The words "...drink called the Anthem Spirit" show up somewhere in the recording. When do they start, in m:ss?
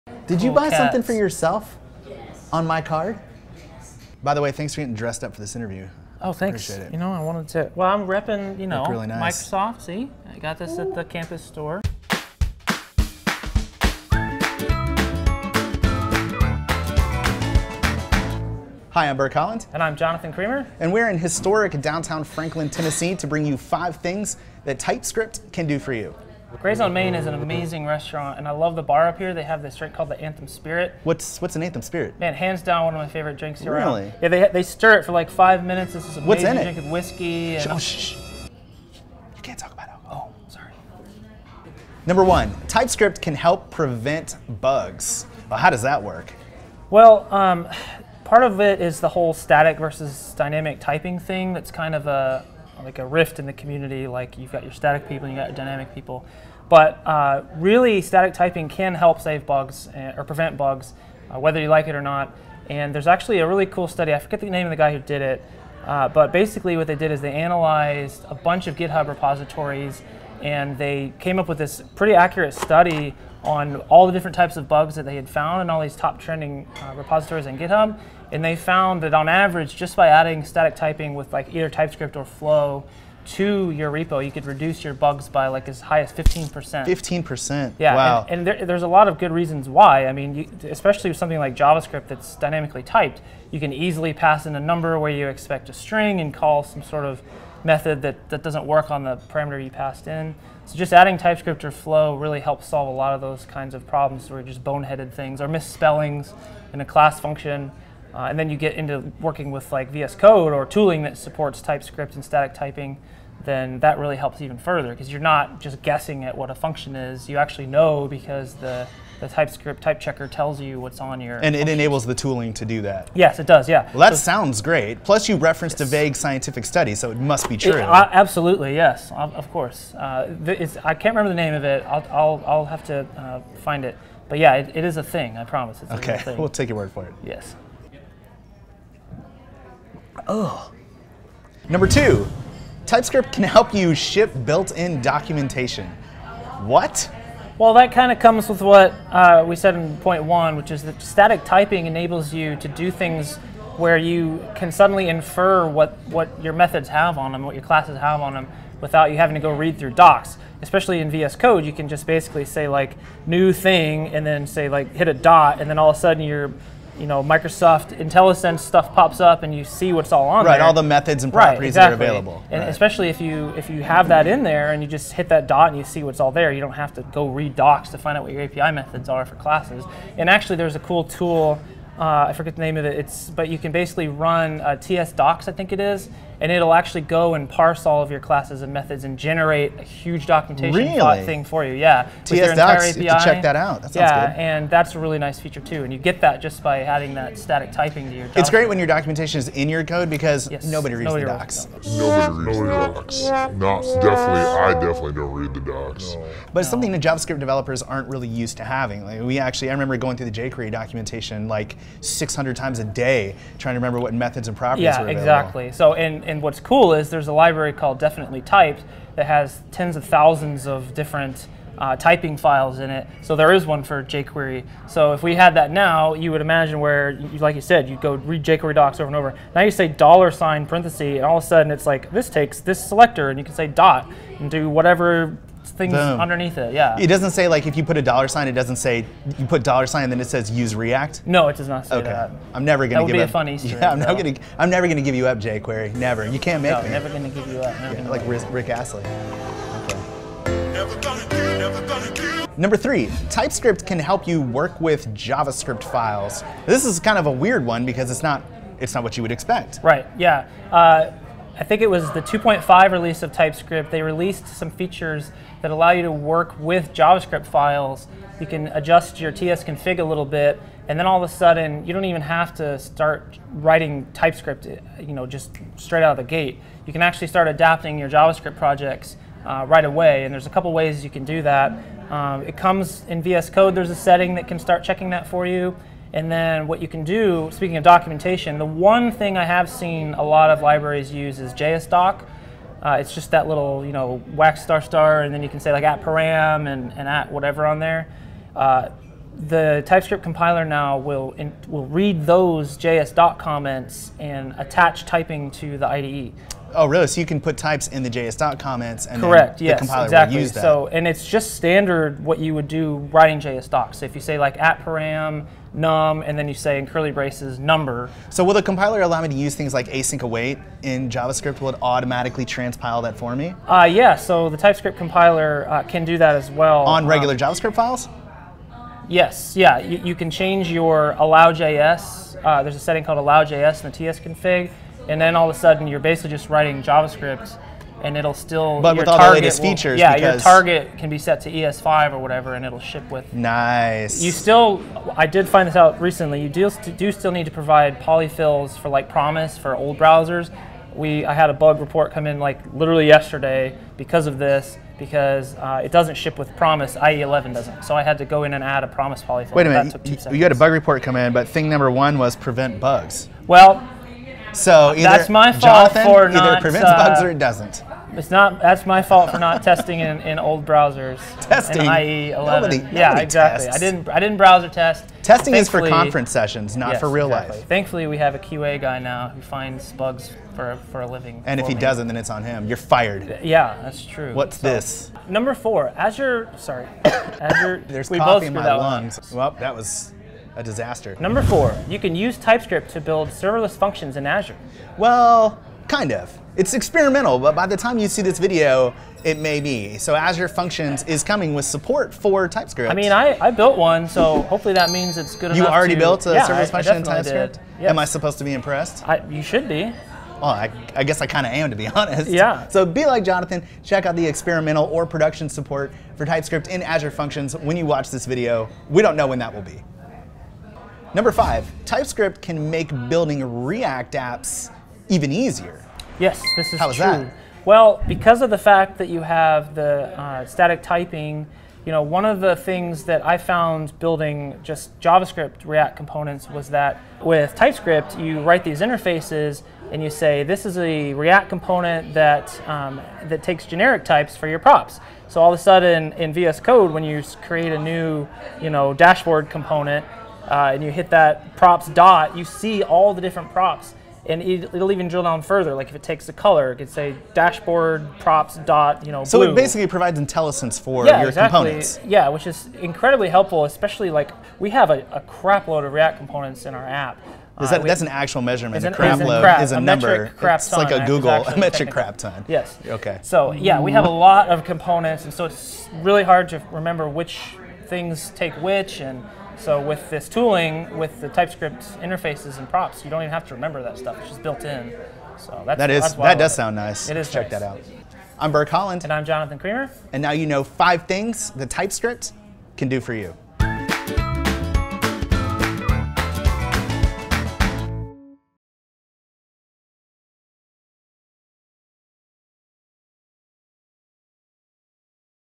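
0:29.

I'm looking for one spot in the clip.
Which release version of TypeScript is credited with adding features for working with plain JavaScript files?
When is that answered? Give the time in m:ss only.
4:22.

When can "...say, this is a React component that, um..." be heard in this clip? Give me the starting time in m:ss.
7:20.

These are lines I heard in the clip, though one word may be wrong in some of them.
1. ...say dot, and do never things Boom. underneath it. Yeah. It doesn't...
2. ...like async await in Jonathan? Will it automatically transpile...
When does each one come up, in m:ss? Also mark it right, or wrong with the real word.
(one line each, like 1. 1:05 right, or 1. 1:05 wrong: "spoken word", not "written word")
1. 3:53 wrong: "whatever", not "never"
2. 5:19 wrong: "JavaScript", not "Jonathan".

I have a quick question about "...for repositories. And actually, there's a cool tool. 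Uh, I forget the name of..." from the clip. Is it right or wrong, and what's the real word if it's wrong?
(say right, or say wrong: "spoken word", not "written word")
wrong: "classes", not "repositories".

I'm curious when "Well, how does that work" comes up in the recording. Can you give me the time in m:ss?
0:45.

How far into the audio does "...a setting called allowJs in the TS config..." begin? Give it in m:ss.
5:32.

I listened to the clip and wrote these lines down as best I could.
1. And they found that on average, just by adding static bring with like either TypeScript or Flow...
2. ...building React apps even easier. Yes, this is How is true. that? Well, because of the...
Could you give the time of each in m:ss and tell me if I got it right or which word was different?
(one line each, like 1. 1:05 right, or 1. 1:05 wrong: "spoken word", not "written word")
1. 1:18 wrong: "typing", not "bring"
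2. 7:03 right.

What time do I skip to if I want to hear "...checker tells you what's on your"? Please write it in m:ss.
1:59.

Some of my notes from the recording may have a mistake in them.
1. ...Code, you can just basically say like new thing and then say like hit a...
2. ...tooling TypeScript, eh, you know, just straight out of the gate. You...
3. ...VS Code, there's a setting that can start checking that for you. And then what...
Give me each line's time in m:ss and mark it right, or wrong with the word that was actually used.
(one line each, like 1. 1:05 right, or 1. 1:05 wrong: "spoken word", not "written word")
1. 2:41 right
2. 4:33 wrong: "writing", not "tooling"
3. 4:43 right.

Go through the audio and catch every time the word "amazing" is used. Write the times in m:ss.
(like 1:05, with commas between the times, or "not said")
0:27, 0:36.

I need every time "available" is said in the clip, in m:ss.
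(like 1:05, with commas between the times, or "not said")
2:52, 3:35.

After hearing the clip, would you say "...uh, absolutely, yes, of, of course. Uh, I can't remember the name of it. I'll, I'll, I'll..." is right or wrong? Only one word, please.
right.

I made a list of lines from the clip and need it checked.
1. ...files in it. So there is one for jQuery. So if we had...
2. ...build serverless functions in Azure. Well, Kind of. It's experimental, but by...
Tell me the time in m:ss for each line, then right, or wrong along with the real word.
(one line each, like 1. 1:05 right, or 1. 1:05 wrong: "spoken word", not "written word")
1. 3:42 right
2. 6:32 right.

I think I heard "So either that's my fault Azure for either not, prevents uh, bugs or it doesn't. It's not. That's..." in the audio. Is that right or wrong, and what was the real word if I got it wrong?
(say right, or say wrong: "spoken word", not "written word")
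wrong: "Jonathan", not "Azure".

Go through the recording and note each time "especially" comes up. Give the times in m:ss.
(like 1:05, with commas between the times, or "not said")
1:30, 2:40, 2:52, 7:43.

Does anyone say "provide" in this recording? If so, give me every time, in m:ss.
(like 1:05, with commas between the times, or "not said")
5:47, 7:39.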